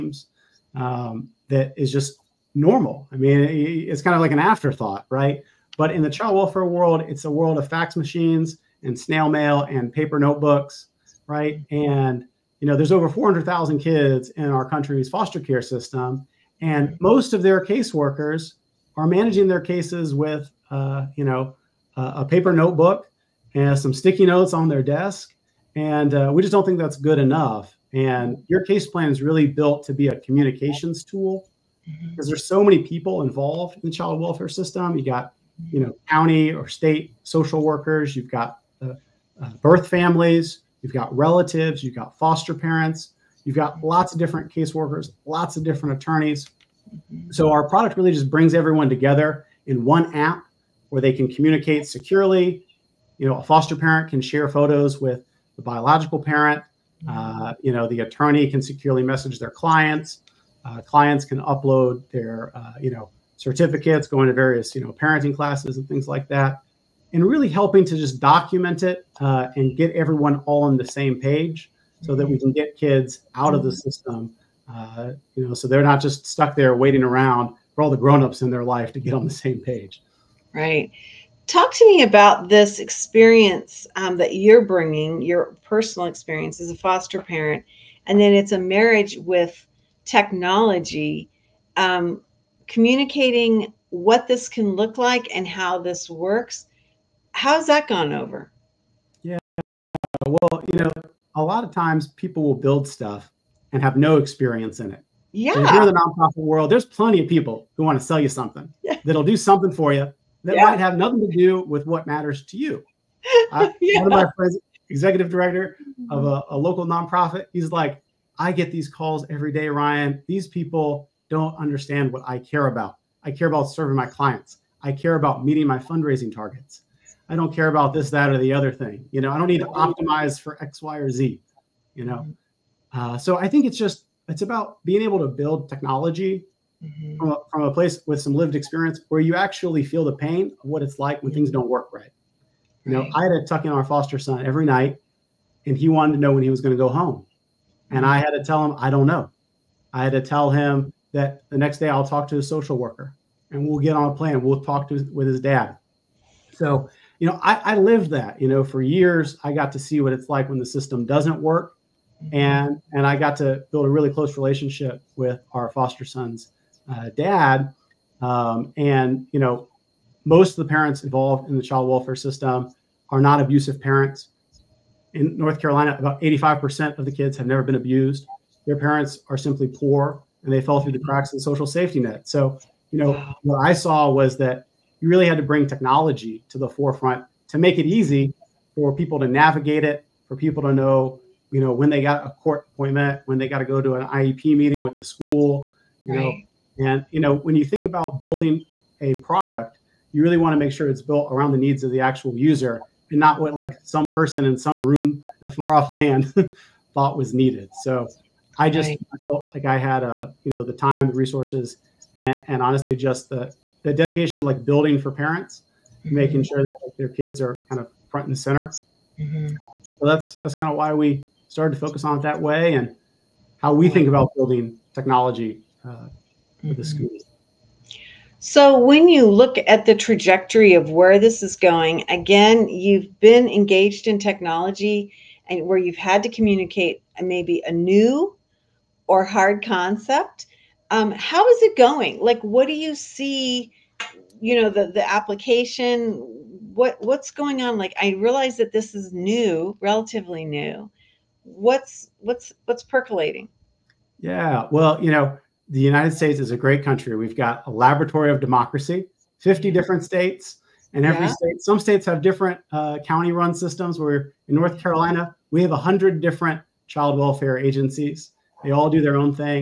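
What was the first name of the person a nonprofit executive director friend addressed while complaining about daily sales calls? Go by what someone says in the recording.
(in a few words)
Ryan.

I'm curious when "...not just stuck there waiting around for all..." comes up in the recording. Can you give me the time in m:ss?
1:15.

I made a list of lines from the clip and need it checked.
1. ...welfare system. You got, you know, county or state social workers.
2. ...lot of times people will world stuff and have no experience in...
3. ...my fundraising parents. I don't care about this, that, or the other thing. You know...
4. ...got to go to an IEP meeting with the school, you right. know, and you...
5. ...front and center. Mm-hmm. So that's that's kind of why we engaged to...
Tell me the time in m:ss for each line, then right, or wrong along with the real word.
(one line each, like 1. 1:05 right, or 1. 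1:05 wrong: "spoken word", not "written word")
1. 0:34 right
2. 1:41 wrong: "build", not "world"
3. 2:05 wrong: "targets", not "parents"
4. 3:13 right
5. 3:38 wrong: "started", not "engaged".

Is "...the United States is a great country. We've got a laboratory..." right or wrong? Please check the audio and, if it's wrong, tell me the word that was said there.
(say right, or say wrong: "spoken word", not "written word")
right.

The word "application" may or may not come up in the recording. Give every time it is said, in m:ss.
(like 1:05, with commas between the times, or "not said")
4:05.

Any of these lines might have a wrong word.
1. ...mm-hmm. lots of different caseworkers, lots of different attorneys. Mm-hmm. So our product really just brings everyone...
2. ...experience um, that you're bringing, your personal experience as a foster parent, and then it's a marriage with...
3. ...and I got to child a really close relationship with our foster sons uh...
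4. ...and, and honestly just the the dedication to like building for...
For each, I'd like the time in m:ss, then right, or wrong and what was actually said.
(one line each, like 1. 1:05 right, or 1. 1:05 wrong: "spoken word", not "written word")
1. 0:43 right
2. 1:22 right
3. 2:42 wrong: "build", not "child"
4. 3:32 right.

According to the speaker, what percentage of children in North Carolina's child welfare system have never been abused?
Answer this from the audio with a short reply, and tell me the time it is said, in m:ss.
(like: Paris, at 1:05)
85%, at 2:56.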